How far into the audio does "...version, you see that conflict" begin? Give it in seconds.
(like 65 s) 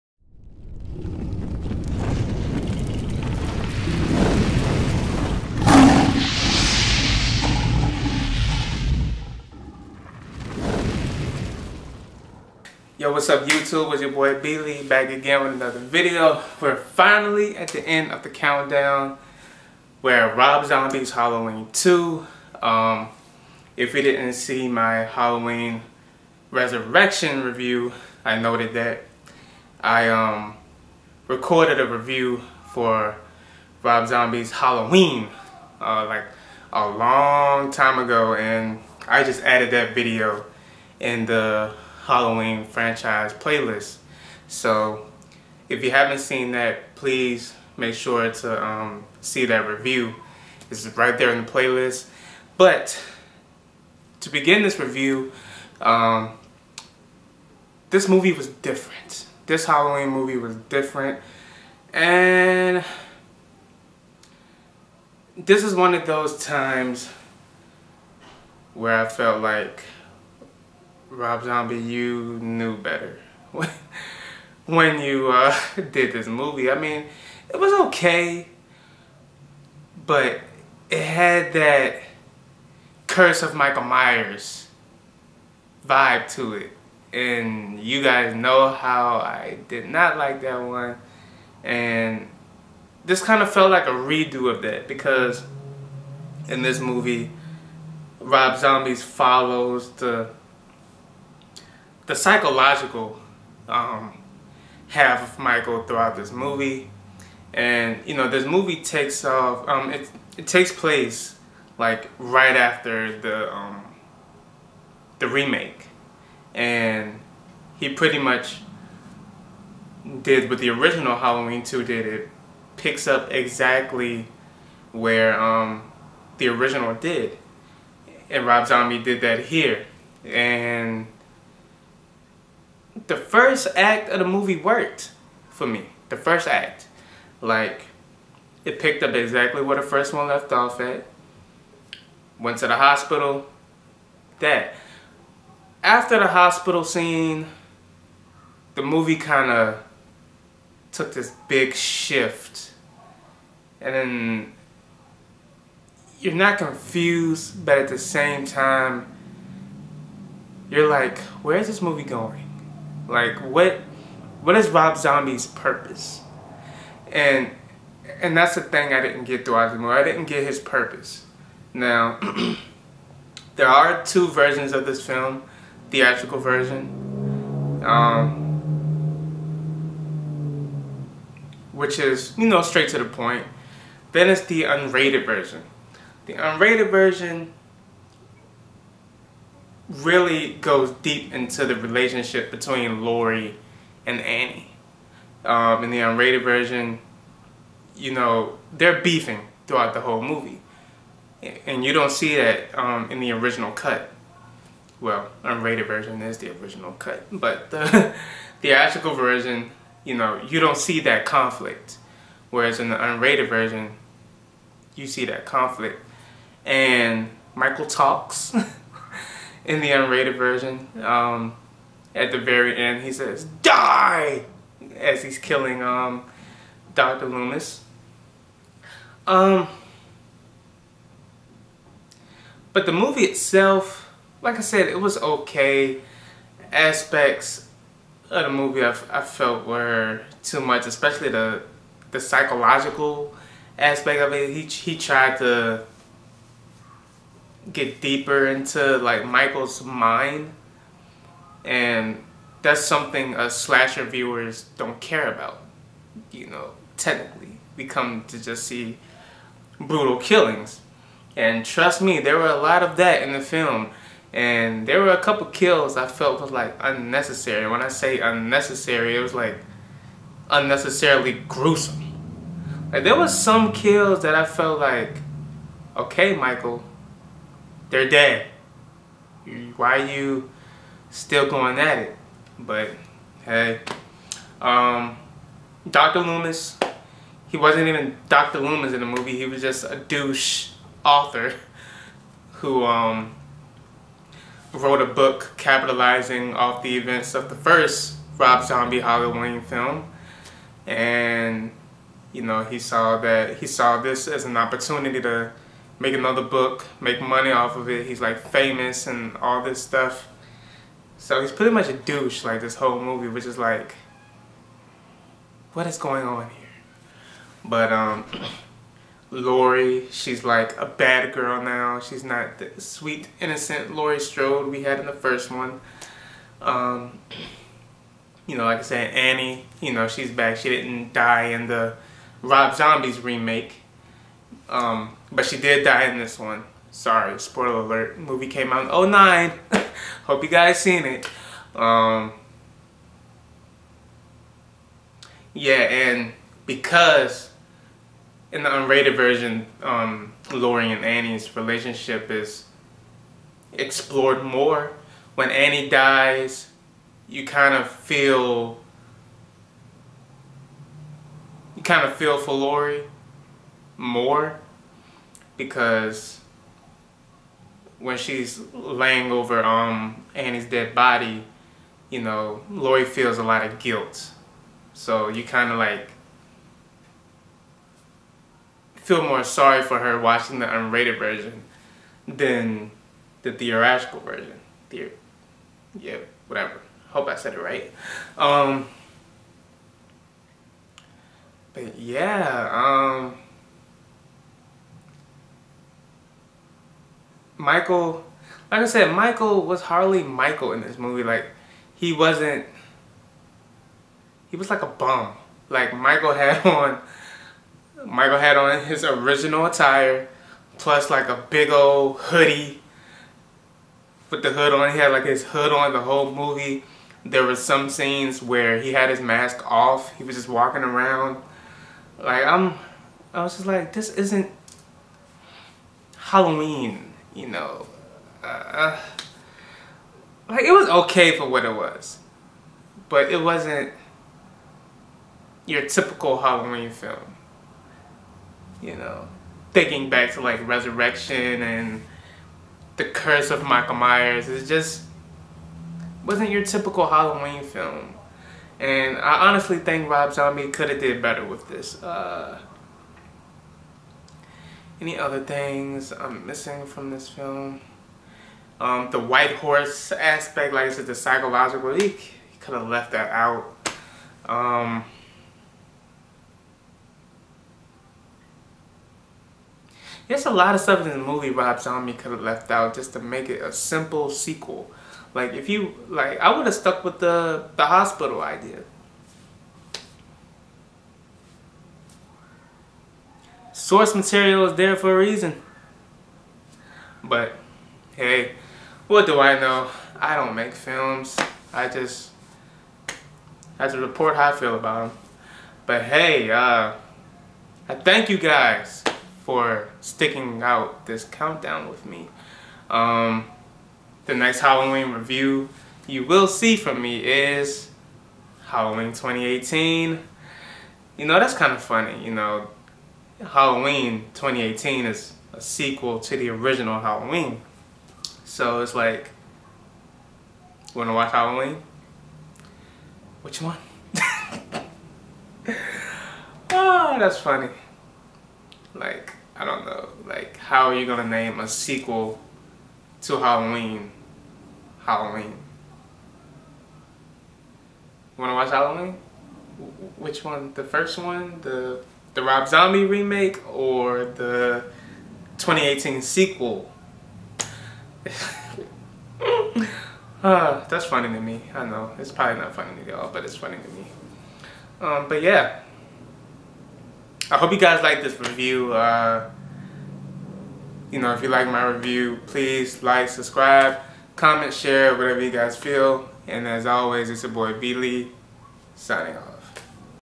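213 s.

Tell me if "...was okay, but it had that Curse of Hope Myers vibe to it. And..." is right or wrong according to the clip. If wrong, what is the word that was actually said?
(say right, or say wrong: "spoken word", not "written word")
wrong: "Michael", not "Hope".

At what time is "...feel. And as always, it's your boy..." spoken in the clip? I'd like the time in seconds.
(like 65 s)
565 s.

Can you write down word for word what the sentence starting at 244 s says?
He he tried to get deeper into like Michael's mind, and that's something us slasher viewers don't care about.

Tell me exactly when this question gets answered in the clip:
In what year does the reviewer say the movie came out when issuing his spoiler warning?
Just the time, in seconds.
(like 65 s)
339 s.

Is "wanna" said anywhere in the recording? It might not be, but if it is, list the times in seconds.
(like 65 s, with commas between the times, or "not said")
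520 s, 538 s.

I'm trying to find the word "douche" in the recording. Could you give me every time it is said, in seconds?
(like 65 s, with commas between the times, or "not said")
289 s, 311 s.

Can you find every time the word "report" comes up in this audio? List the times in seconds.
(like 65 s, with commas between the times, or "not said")
493 s.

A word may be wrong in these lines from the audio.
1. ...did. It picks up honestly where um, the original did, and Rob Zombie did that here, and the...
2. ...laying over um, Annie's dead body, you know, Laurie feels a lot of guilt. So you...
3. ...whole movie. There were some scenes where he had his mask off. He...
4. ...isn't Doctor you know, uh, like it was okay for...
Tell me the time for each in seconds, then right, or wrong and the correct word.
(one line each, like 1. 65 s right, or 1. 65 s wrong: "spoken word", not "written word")
1. 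121 s wrong: "exactly", not "honestly"
2. 368 s right
3. 416 s right
4. 424 s wrong: "Halloween", not "Doctor".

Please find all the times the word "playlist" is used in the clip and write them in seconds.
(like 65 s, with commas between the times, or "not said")
43 s, 51 s.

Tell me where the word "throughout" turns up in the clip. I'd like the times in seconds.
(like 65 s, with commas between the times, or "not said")
105 s, 169 s, 199 s.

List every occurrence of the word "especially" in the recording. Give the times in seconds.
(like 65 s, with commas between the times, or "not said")
240 s.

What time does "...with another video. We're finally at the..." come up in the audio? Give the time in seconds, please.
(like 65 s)
15 s.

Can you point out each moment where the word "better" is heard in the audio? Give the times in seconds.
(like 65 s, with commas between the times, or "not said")
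72 s, 451 s.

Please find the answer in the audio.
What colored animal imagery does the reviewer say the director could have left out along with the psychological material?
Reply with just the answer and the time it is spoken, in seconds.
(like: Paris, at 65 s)
White horse, at 459 s.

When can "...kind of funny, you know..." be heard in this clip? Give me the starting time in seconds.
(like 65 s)
511 s.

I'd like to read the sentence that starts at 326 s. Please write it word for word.
Um, you know, like I said, Annie, you know, she's back.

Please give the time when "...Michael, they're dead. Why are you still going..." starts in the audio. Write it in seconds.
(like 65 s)
276 s.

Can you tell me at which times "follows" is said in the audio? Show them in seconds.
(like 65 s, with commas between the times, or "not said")
99 s.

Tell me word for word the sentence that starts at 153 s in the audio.
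And then you're not confused, but at the same time, you're like, where is this movie going?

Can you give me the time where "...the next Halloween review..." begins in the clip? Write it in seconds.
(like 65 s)
504 s.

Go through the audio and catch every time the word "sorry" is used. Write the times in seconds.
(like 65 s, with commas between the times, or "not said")
336 s, 379 s.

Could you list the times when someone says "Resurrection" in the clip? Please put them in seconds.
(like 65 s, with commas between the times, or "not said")
26 s, 440 s.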